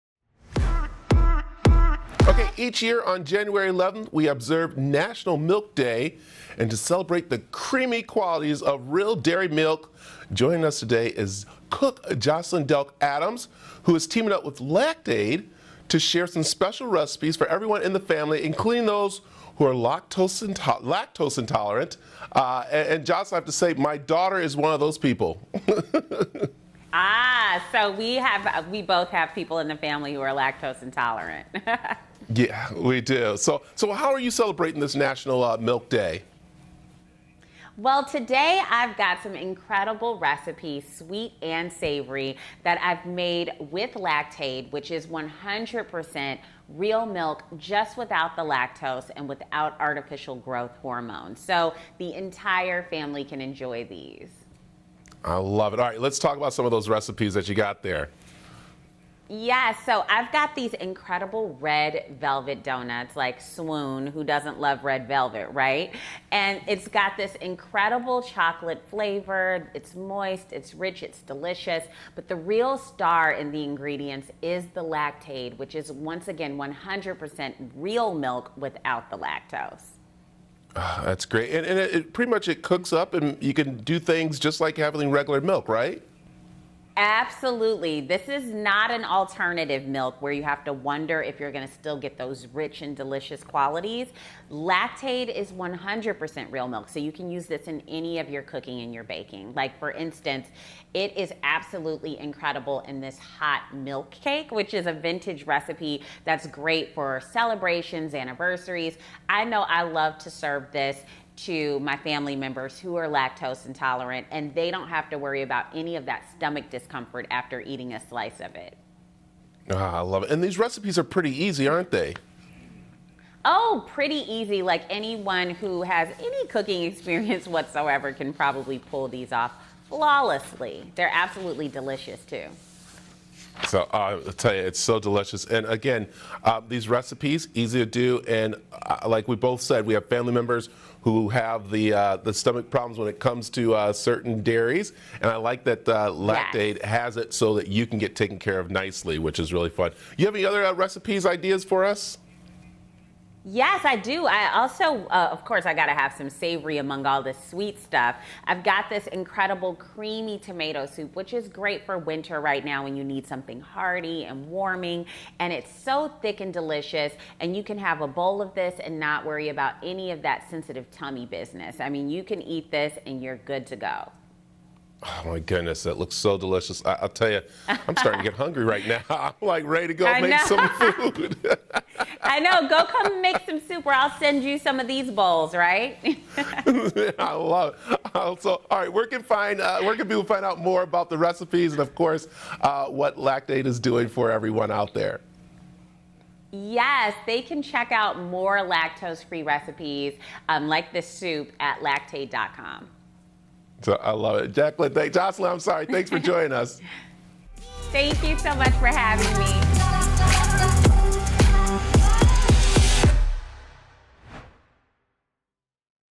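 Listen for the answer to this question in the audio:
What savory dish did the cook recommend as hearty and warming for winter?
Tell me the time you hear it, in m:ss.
2:39.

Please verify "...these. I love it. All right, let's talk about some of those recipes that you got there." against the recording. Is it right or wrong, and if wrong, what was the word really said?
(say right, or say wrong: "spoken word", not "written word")
right.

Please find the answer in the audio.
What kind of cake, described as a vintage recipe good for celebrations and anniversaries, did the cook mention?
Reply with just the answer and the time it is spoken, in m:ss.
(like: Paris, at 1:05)
Hot milk cake, at 1:43.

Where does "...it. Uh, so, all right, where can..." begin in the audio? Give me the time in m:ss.
3:07.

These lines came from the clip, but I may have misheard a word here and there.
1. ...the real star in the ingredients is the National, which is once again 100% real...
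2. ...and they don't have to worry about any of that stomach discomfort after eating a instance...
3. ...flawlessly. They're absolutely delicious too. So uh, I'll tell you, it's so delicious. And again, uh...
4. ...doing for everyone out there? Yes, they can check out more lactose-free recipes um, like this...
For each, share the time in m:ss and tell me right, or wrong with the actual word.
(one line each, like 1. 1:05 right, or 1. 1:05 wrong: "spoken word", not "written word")
1. 1:12 wrong: "Lactaid", not "National"
2. 1:54 wrong: "slice", not "instance"
3. 2:09 right
4. 3:13 right.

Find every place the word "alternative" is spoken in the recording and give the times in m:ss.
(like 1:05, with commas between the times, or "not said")
1:29.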